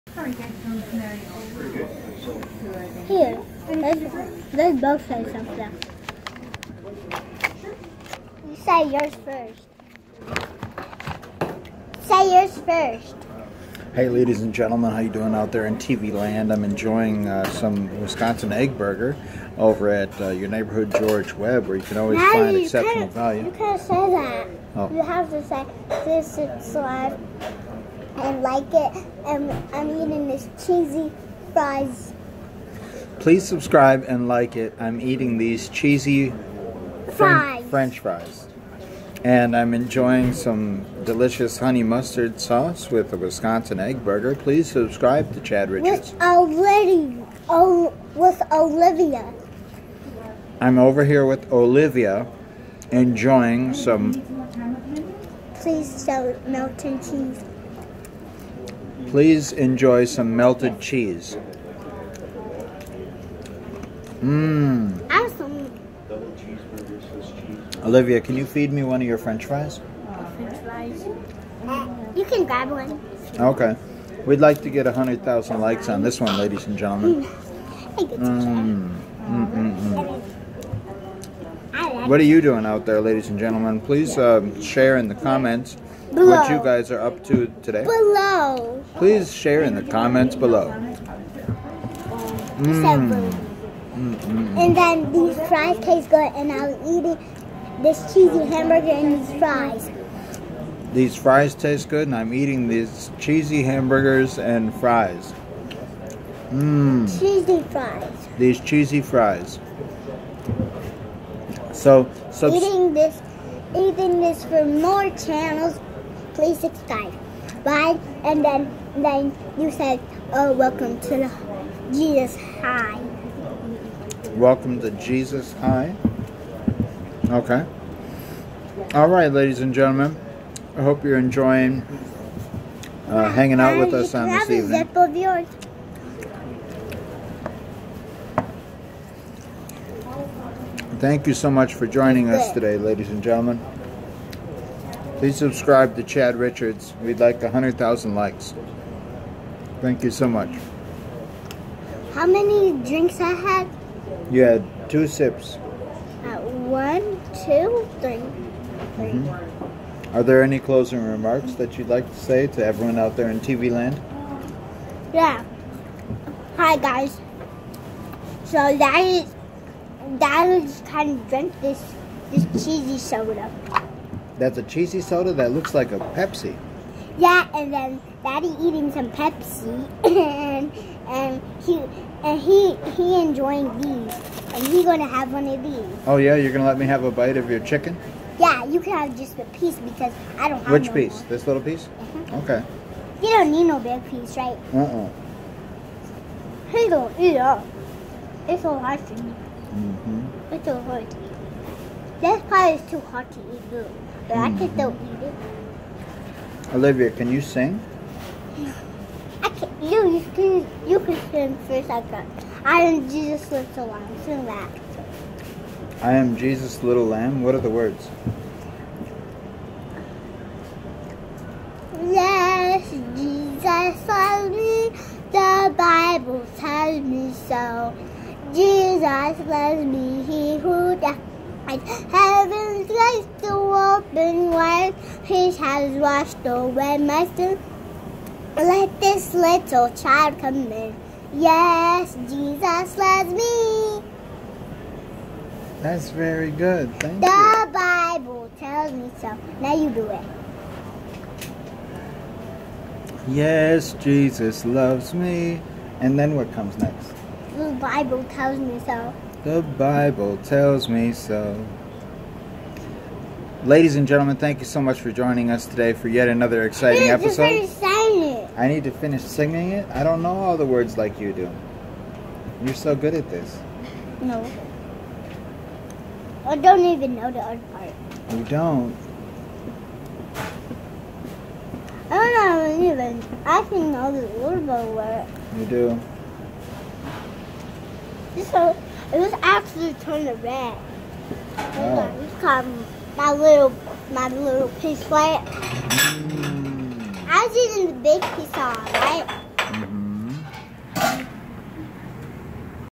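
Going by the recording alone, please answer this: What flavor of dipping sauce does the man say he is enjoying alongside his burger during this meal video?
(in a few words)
honey mustard.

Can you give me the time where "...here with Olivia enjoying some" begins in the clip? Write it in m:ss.
0:51.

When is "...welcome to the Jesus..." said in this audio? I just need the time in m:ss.
2:00.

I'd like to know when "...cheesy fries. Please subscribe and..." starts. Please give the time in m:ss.
0:30.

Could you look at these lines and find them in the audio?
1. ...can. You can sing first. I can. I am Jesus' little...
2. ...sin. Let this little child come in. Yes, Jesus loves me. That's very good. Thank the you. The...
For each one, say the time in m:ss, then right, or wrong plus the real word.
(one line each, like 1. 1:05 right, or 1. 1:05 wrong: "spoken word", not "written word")
1. 3:30 right
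2. 3:57 right.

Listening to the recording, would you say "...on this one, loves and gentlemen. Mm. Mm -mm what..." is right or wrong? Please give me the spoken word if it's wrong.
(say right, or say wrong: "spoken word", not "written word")
wrong: "ladies", not "loves".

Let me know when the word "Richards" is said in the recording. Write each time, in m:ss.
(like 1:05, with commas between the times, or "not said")
0:45, 2:26.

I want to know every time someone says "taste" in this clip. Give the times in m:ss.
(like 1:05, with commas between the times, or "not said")
1:35, 1:41.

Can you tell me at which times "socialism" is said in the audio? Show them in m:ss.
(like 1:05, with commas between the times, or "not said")
not said.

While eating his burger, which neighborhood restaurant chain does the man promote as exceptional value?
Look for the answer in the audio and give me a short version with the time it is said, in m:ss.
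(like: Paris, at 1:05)
George Webb, at 0:20.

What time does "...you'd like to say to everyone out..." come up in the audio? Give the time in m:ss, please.
2:41.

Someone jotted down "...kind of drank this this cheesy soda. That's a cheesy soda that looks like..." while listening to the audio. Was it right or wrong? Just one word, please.
right.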